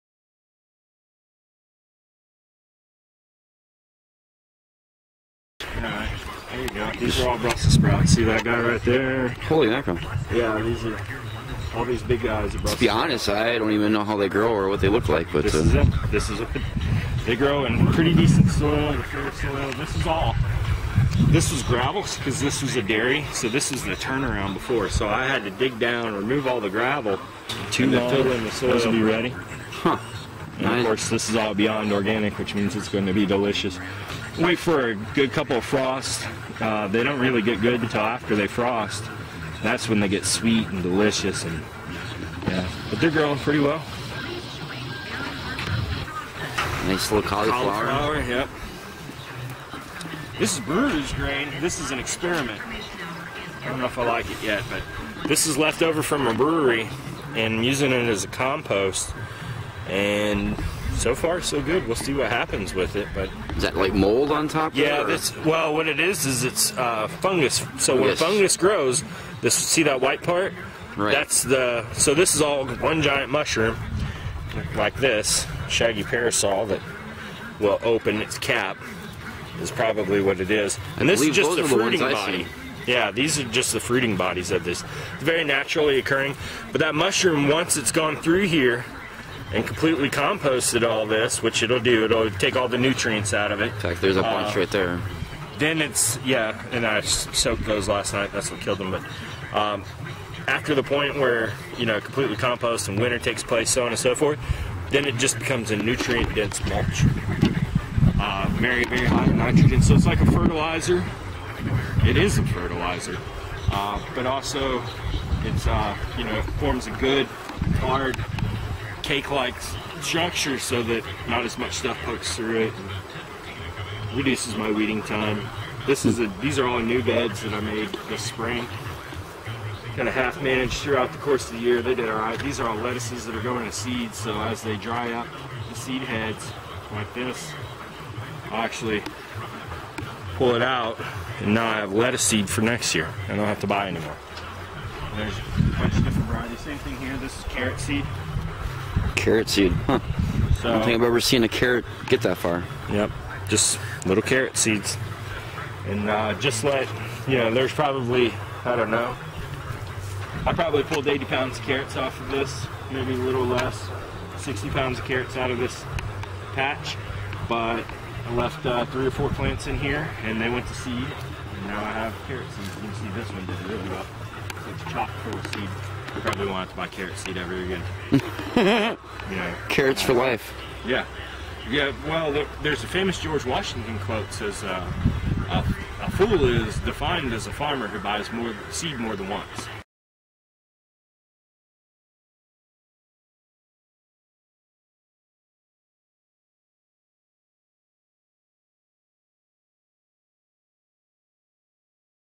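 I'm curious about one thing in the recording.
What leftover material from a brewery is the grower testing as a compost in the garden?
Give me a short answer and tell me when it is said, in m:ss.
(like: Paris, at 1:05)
brewer's grain, at 0:50.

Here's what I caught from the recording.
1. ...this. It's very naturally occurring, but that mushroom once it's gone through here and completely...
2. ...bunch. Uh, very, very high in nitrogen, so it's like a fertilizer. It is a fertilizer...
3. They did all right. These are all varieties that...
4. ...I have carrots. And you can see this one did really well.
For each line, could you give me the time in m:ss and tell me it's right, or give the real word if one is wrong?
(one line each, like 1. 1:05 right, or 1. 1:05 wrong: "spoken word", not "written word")
1. 1:24 right
2. 1:46 wrong: "mulch", not "bunch"
3. 2:11 wrong: "lettuces", not "varieties"
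4. 2:51 right.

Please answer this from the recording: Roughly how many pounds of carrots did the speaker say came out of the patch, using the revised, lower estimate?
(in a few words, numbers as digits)
60.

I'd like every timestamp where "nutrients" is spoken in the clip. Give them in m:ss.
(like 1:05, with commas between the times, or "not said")
1:32, 1:45.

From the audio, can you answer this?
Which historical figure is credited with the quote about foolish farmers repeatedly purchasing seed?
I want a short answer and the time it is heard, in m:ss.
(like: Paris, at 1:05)
George Washington, at 3:03.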